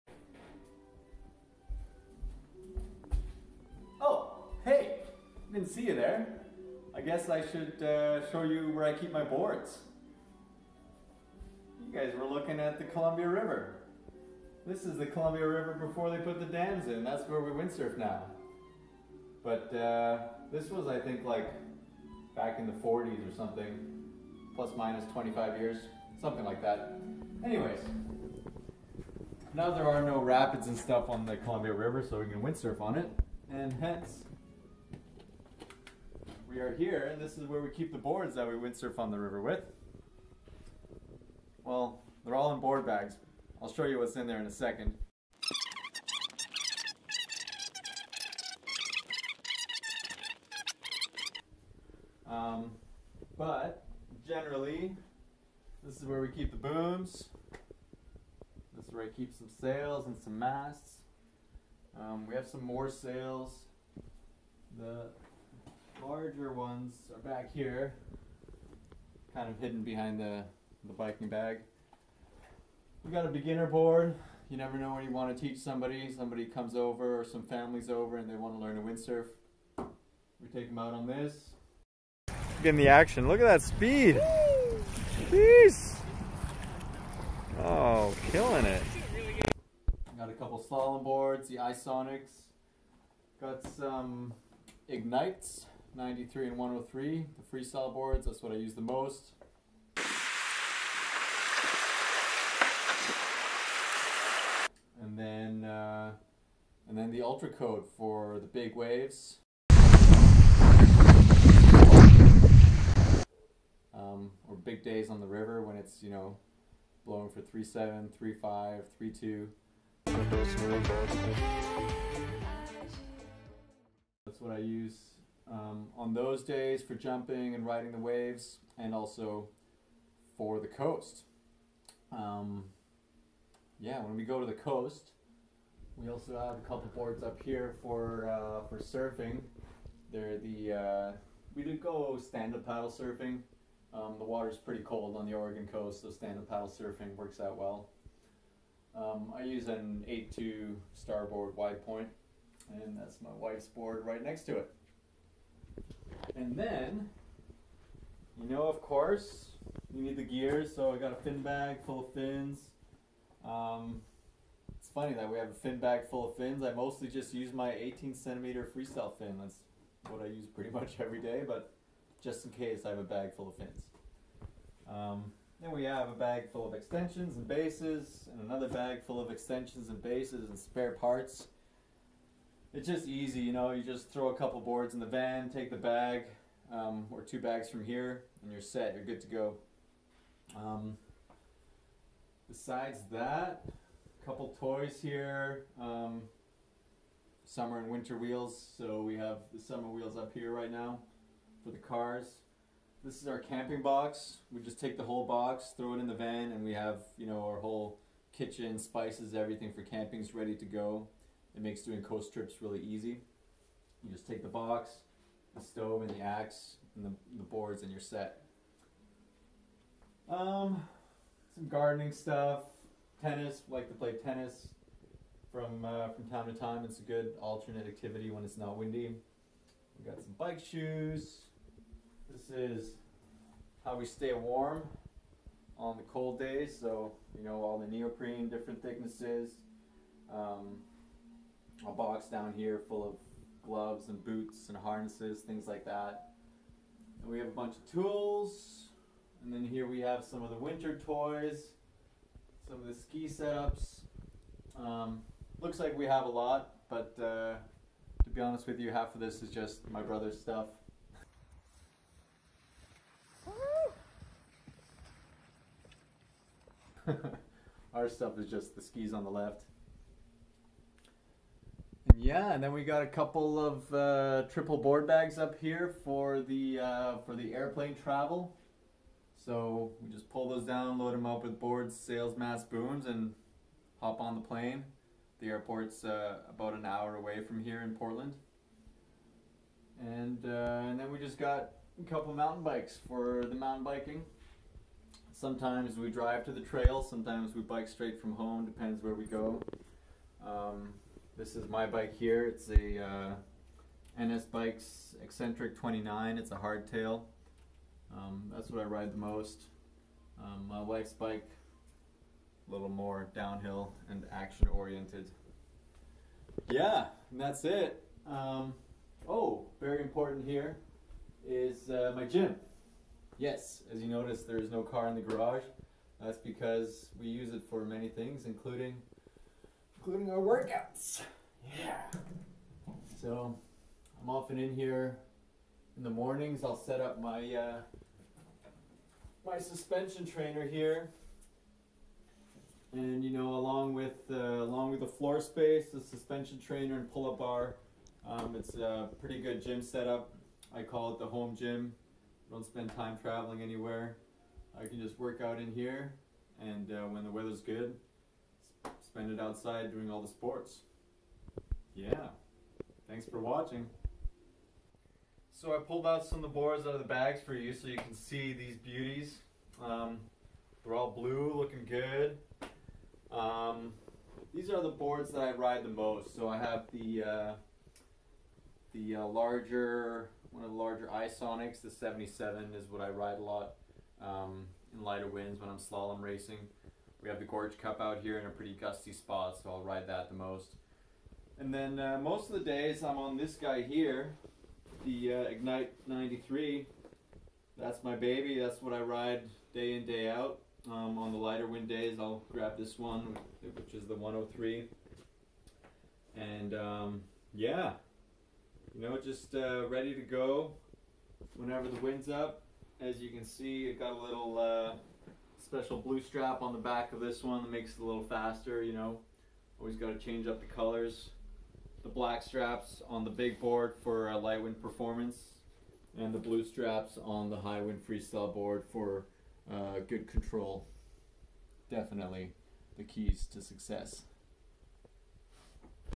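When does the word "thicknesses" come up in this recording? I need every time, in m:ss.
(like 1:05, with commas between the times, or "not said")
3:58.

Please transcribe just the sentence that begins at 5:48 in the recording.
Um, it's a pretty good gym setup.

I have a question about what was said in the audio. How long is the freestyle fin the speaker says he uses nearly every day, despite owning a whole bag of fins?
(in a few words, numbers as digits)
18 centimeters.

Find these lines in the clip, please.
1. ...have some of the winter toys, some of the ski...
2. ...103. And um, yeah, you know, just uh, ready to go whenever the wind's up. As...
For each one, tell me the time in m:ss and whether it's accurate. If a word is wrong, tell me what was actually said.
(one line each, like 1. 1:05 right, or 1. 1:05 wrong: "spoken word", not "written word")
1. 4:10 right
2. 6:44 right.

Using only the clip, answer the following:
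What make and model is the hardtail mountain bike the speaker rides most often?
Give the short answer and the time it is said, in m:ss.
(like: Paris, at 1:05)
NS Bikes Eccentric 29, at 5:04.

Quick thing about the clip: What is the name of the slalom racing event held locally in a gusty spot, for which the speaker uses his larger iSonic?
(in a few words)
Gorge Cup.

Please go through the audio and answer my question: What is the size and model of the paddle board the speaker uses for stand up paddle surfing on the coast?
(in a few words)
8-2 Starboard Widepoint.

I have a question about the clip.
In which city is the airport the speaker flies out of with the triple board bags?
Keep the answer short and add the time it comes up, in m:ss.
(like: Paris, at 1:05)
Portland, at 4:47.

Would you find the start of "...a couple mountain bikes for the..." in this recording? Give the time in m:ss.
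4:51.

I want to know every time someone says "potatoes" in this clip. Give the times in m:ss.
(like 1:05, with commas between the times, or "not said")
not said.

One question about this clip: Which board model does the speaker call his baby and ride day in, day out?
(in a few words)
Ignite 93.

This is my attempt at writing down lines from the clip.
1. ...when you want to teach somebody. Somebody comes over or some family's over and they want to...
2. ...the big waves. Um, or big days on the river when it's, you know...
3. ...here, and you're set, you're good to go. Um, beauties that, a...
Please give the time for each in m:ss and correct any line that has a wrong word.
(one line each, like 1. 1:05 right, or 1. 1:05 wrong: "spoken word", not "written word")
1. 1:14 right
2. 1:48 right
3. 3:07 wrong: "besides", not "beauties".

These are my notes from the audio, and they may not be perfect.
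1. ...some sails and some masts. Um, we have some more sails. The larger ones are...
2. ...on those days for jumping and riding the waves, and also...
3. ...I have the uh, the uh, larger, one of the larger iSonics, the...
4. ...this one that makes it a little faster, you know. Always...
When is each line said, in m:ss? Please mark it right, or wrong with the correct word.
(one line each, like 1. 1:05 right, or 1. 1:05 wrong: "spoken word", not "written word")
1. 0:59 right
2. 2:05 right
3. 6:16 right
4. 6:57 right.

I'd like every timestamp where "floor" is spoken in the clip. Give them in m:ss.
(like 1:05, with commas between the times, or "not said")
5:45.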